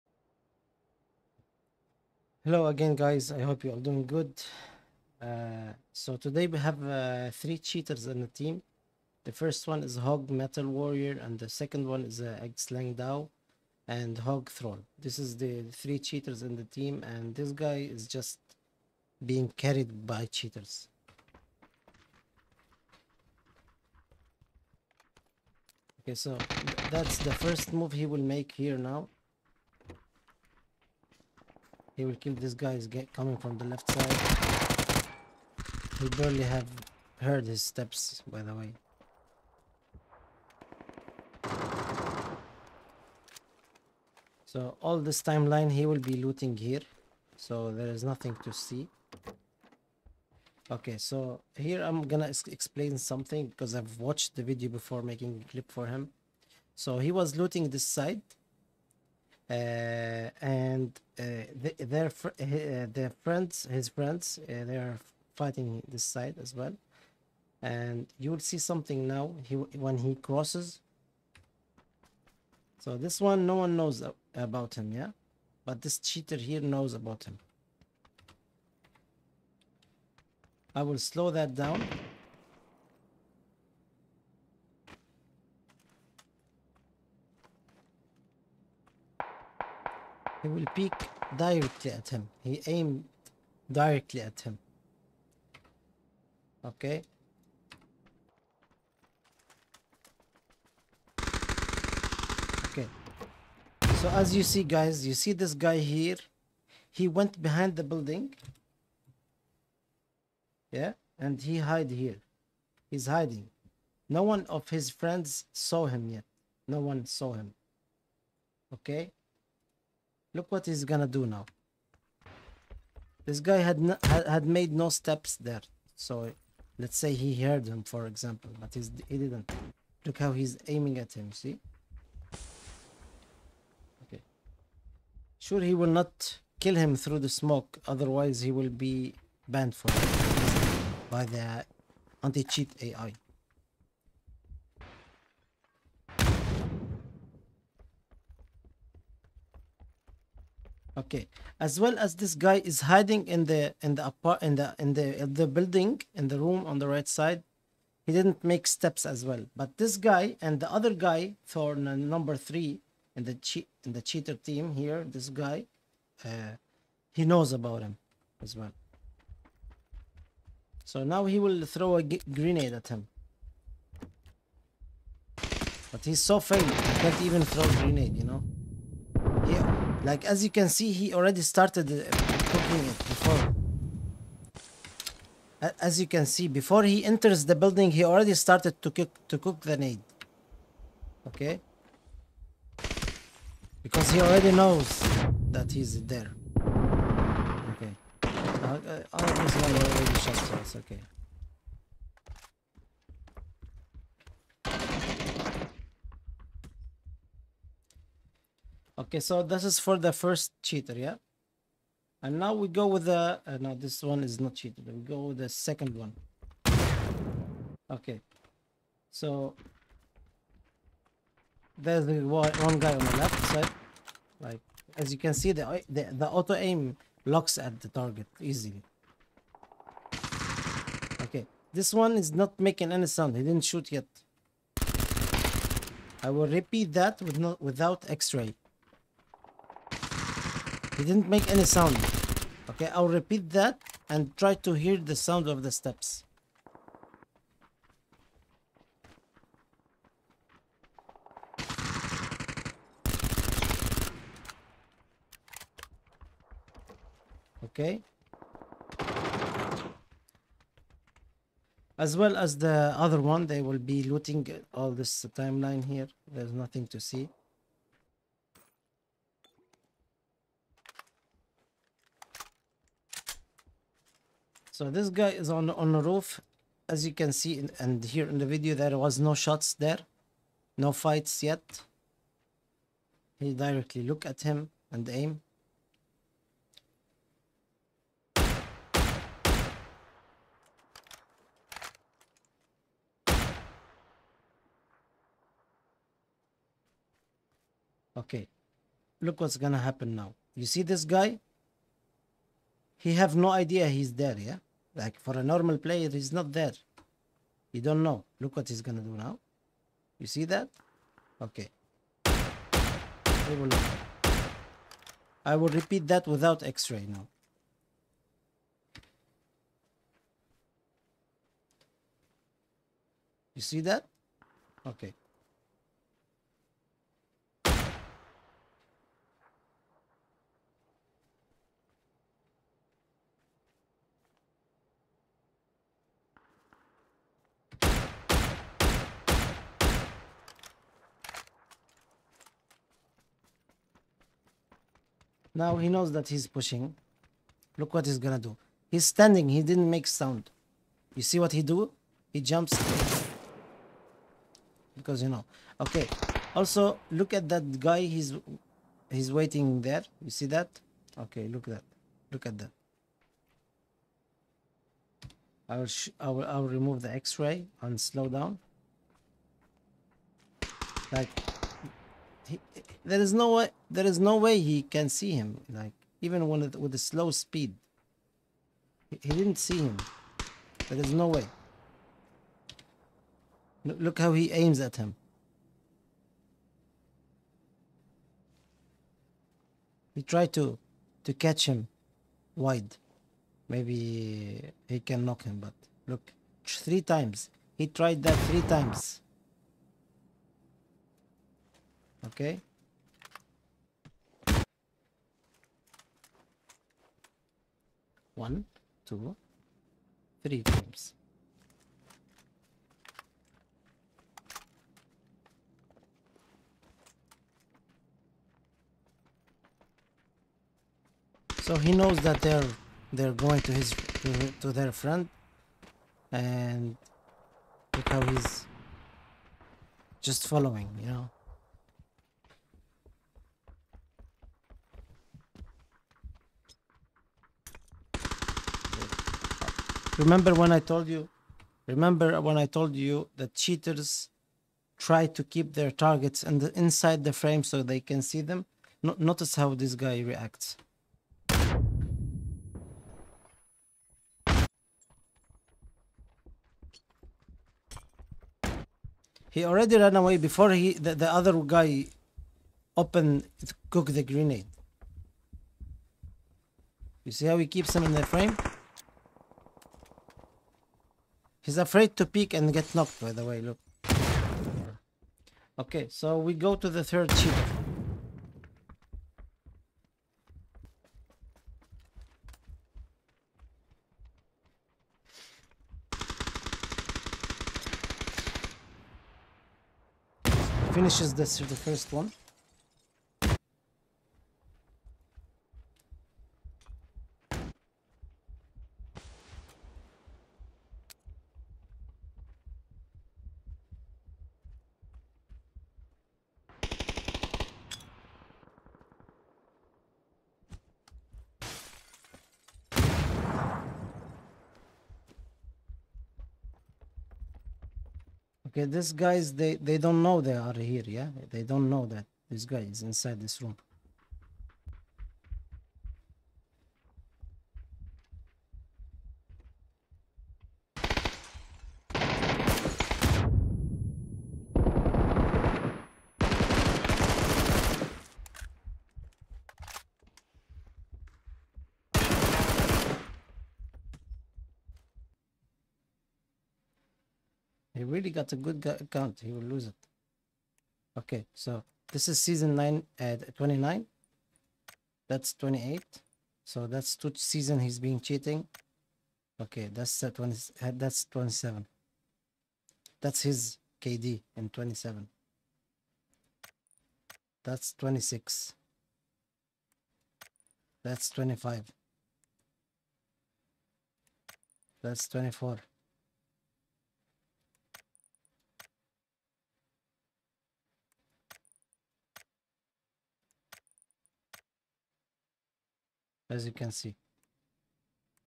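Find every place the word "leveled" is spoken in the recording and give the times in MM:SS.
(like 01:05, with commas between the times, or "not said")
not said.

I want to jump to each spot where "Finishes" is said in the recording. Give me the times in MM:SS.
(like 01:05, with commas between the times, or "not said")
08:10.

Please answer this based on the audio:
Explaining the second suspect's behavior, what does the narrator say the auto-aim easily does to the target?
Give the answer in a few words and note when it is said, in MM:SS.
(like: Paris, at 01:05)
locks at the target, at 03:47.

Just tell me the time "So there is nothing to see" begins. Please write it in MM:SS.
00:47.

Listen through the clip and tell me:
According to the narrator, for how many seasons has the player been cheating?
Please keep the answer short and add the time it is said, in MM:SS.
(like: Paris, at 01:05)
2, at 09:17.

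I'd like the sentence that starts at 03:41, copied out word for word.
There's the one guy on the left side.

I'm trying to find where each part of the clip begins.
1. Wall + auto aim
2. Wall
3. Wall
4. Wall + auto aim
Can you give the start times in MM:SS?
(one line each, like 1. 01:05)
1. 00:32
2. 01:45
3. 01:20
4. 02:30.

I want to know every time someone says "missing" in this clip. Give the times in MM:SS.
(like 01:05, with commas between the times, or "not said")
not said.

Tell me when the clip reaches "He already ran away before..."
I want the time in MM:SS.
07:39.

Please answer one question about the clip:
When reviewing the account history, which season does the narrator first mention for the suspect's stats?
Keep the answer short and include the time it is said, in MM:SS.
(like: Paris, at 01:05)
Season 9, at 09:12.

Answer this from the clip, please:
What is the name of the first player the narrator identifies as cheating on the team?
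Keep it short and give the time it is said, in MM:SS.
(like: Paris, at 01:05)
Hog Metal Warrior, at 00:09.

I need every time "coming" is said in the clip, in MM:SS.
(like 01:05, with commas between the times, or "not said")
00:33.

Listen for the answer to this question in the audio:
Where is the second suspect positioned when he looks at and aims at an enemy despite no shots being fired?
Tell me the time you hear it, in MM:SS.
04:35.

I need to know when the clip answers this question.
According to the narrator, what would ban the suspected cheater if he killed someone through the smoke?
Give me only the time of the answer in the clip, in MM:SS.
02:22.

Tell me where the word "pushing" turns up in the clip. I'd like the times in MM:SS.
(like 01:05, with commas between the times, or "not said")
05:46.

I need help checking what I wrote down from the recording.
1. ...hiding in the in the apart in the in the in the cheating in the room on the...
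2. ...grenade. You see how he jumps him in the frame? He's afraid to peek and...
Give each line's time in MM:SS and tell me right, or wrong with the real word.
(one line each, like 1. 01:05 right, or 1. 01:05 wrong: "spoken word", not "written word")
1. 02:32 wrong: "building", not "cheating"
2. 07:44 wrong: "keeps", not "jumps".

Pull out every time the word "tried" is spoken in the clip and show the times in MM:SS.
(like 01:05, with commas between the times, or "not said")
06:37.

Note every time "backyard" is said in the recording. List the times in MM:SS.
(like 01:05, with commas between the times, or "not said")
not said.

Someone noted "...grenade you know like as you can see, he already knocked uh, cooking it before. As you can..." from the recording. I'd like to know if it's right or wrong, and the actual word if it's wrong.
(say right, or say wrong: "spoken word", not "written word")
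wrong: "started", not "knocked".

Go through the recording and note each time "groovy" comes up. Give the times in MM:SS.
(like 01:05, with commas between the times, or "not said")
not said.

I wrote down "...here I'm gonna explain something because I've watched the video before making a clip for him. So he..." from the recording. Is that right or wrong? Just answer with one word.
right.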